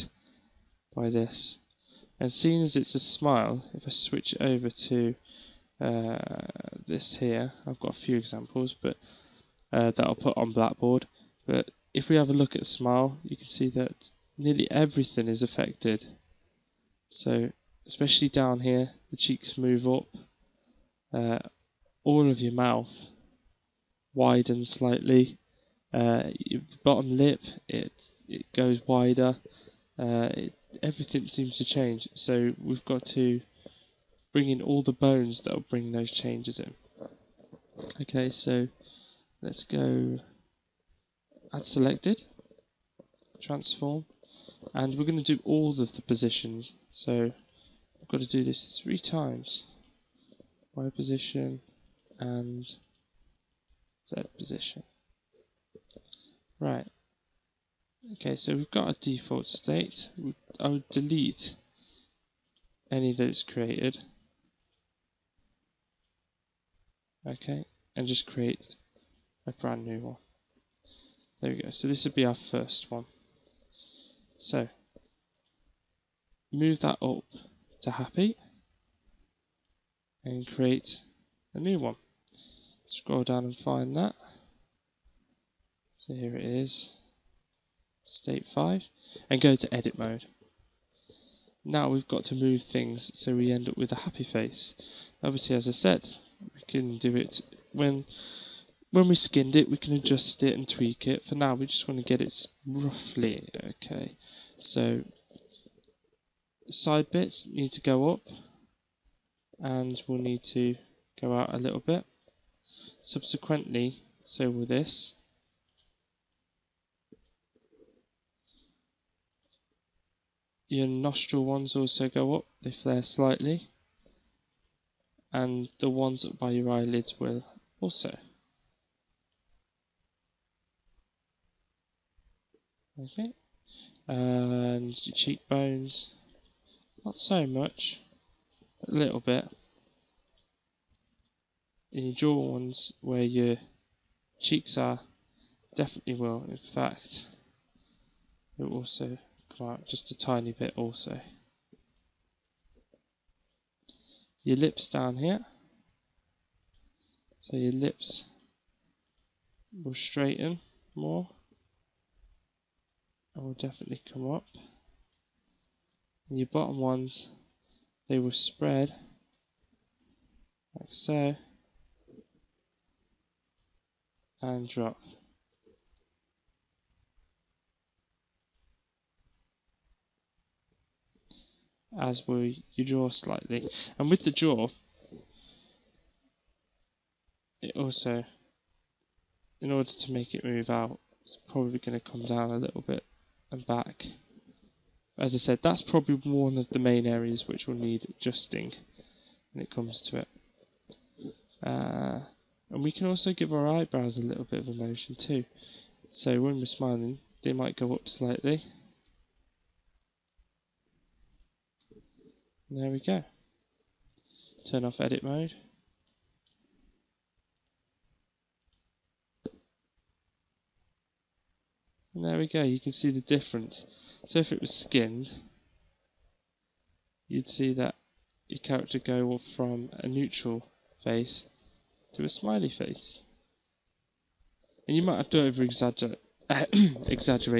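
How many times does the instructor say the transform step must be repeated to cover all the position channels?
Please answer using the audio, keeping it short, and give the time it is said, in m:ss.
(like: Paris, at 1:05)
3, at 0:48.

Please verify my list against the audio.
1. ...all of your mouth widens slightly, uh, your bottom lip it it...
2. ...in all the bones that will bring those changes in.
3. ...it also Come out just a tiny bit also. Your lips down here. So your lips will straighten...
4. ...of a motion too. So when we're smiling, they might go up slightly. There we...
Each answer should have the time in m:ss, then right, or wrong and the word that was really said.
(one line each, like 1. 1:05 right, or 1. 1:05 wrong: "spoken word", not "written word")
1. 0:22 right
2. 0:34 right
3. 2:28 right
4. 3:24 right.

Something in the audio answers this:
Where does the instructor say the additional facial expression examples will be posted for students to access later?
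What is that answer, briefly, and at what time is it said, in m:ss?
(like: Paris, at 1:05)
Blackboard, at 0:10.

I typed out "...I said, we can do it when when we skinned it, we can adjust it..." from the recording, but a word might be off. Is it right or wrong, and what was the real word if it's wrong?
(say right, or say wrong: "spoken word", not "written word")
right.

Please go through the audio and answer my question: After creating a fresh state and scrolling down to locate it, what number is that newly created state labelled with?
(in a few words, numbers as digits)
State 5.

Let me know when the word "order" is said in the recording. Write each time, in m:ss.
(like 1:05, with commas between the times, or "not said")
3:09.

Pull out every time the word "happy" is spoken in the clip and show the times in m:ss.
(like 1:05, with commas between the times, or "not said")
1:17, 1:33.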